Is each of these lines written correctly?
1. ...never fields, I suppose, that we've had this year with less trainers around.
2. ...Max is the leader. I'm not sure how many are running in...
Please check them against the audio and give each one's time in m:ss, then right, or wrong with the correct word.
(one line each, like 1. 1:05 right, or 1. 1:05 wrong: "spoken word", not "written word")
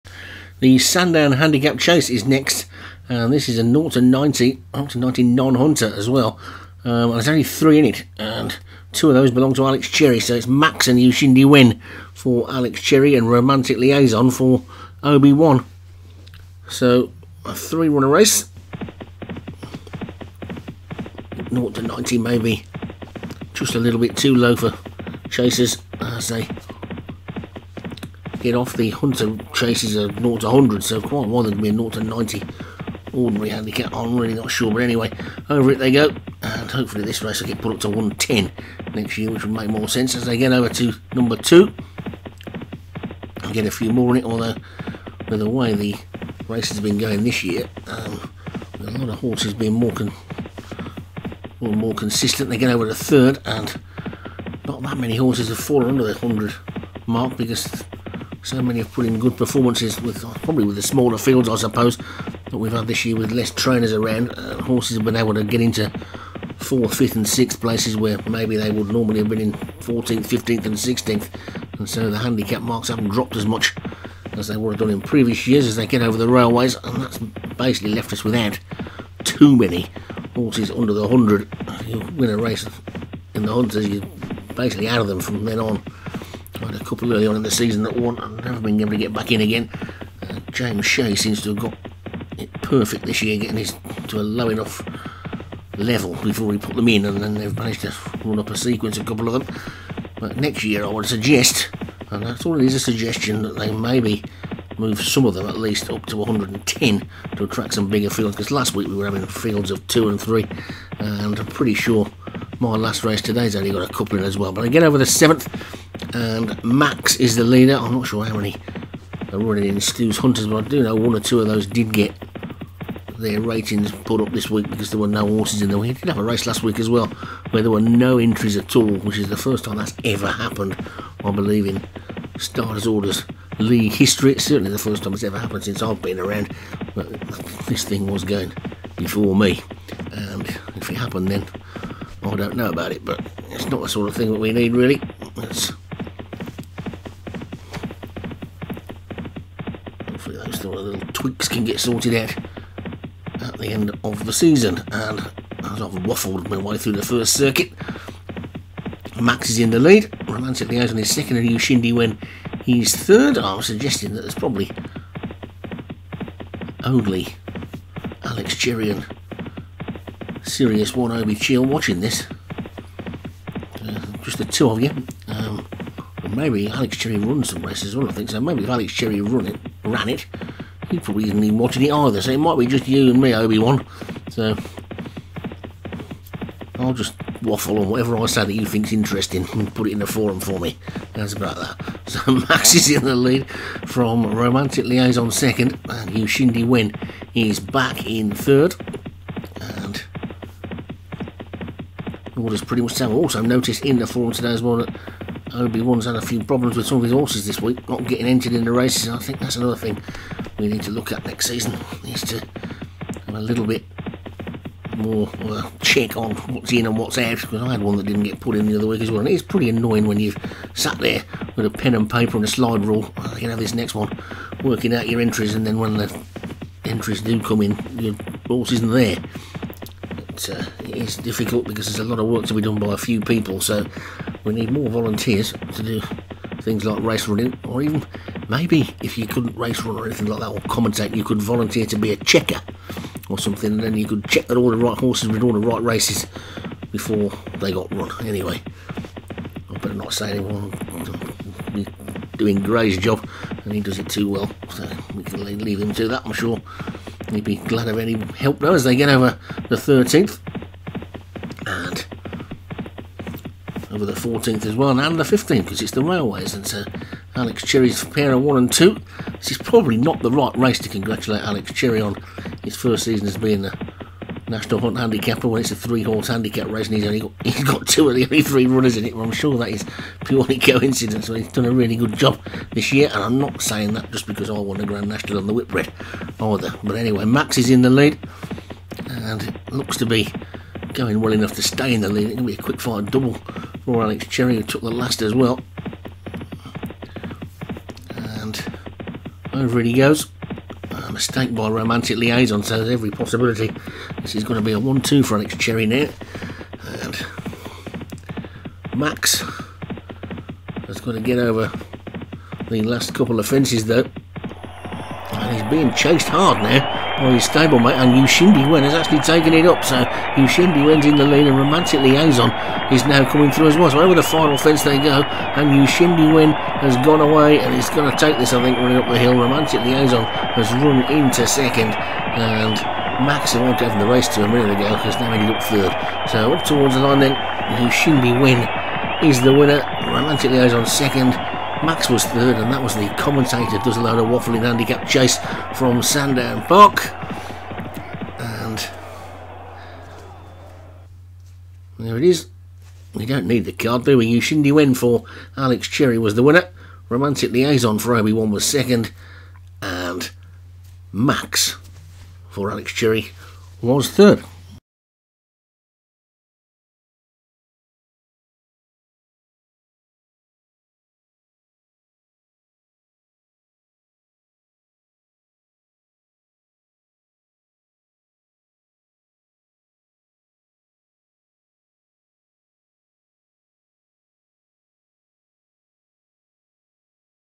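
1. 1:00 wrong: "smaller", not "never"
2. 1:56 right.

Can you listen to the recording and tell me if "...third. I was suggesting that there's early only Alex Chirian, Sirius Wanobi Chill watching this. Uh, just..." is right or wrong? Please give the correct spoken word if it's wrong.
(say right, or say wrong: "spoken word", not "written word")
wrong: "probably", not "early".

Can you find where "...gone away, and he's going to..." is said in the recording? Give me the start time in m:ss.
5:27.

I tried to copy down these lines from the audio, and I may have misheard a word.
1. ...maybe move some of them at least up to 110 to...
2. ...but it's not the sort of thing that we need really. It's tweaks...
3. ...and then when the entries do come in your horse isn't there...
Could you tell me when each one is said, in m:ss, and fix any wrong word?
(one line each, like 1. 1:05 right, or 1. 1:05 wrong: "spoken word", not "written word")
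1. 1:43 right
2. 2:23 right
3. 3:45 right.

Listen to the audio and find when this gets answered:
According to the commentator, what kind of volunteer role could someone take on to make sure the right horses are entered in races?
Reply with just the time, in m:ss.
4:02.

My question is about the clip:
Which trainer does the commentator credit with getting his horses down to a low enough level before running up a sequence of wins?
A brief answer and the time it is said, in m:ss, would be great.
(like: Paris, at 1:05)
James Shea, at 1:30.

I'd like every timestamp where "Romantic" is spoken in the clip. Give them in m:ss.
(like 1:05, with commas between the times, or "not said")
0:13, 2:40, 3:14, 5:01, 5:21, 5:29, 5:40, 5:57.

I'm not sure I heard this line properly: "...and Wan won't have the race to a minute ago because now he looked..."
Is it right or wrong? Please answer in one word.
wrong.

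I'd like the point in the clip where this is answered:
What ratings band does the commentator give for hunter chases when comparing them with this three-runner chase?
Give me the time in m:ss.
0:30.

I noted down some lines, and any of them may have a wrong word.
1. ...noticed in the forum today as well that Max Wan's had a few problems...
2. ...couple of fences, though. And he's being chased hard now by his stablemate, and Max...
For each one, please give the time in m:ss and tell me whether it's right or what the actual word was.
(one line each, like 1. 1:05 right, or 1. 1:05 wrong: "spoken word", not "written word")
1. 3:23 wrong: "Obi", not "Max"
2. 5:13 wrong: "Yushindi", not "Max".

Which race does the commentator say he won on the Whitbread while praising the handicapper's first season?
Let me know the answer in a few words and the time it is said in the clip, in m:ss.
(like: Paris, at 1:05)
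Grand National, at 4:44.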